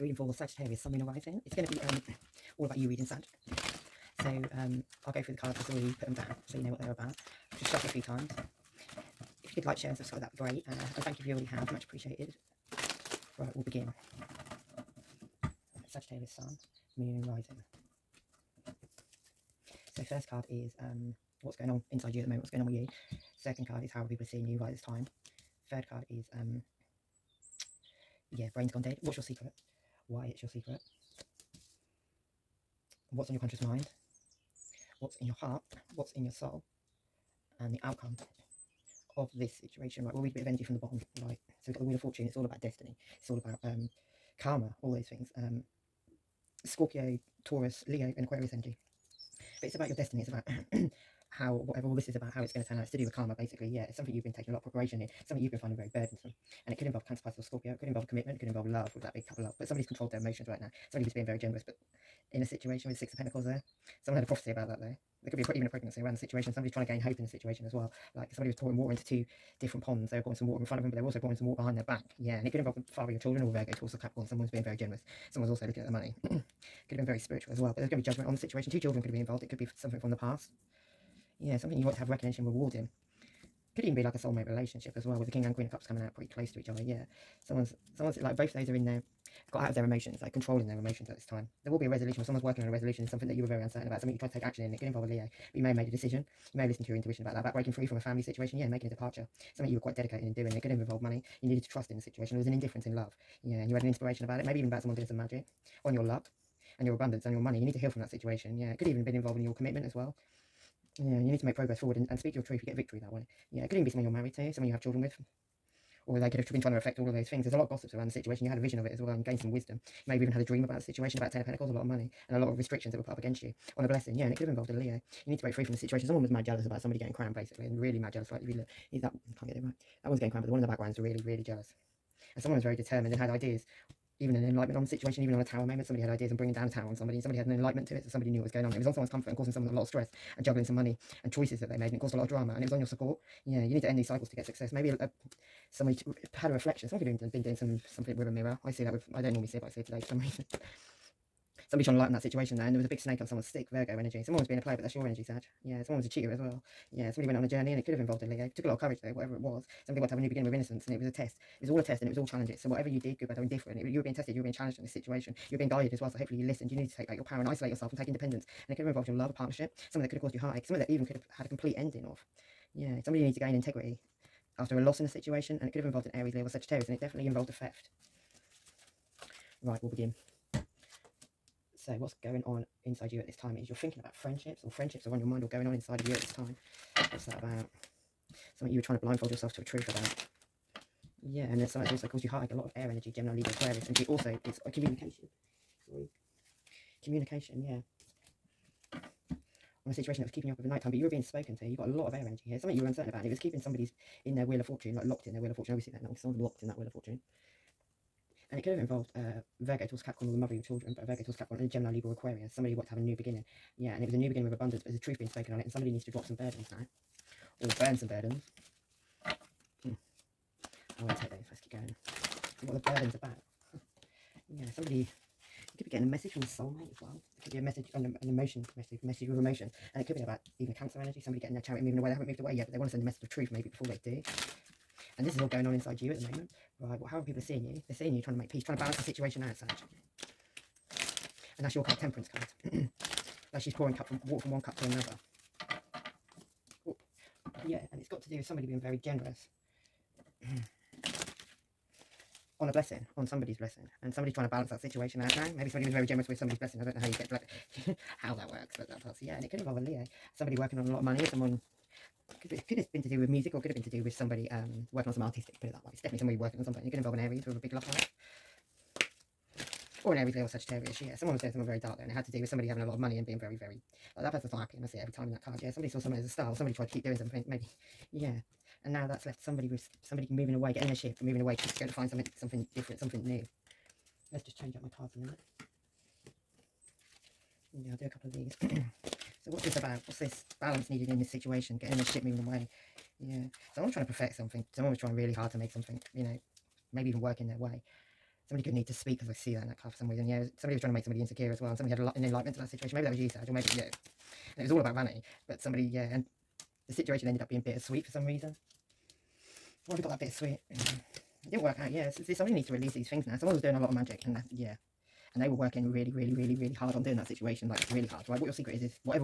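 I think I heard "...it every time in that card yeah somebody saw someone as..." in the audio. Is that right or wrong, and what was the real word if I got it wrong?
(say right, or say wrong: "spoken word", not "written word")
right.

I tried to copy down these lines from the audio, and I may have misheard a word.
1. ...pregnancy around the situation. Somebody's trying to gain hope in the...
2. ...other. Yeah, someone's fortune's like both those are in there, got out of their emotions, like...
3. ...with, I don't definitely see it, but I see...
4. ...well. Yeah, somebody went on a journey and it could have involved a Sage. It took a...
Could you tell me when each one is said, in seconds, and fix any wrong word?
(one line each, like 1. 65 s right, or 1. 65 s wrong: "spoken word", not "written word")
1. 65 s right
2. 86 s wrong: "someone", not "fortune"
3. 148 s wrong: "normally", not "definitely"
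4. 156 s wrong: "Leo", not "Sage".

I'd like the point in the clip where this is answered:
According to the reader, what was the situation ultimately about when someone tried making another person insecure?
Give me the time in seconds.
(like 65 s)
304 s.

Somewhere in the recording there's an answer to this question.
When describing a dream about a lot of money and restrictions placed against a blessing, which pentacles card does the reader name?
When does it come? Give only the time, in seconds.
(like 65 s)
121 s.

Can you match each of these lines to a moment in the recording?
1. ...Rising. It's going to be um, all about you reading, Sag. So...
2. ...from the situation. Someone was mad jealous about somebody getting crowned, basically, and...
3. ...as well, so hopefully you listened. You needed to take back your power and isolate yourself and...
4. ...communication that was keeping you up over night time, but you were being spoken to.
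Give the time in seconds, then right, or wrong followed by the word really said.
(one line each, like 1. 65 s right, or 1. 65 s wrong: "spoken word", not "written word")
1. 1 s right
2. 125 s right
3. 165 s right
4. 199 s wrong: "situation", not "communication".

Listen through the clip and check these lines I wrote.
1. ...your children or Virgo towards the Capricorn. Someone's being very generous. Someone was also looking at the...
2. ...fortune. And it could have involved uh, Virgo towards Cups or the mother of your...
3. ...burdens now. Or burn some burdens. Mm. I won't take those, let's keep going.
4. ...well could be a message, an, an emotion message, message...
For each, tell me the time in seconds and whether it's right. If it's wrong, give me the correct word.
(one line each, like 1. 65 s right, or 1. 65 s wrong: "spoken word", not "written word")
1. 73 s right
2. 206 s wrong: "Capricorn", not "Cups"
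3. 216 s right
4. 227 s right.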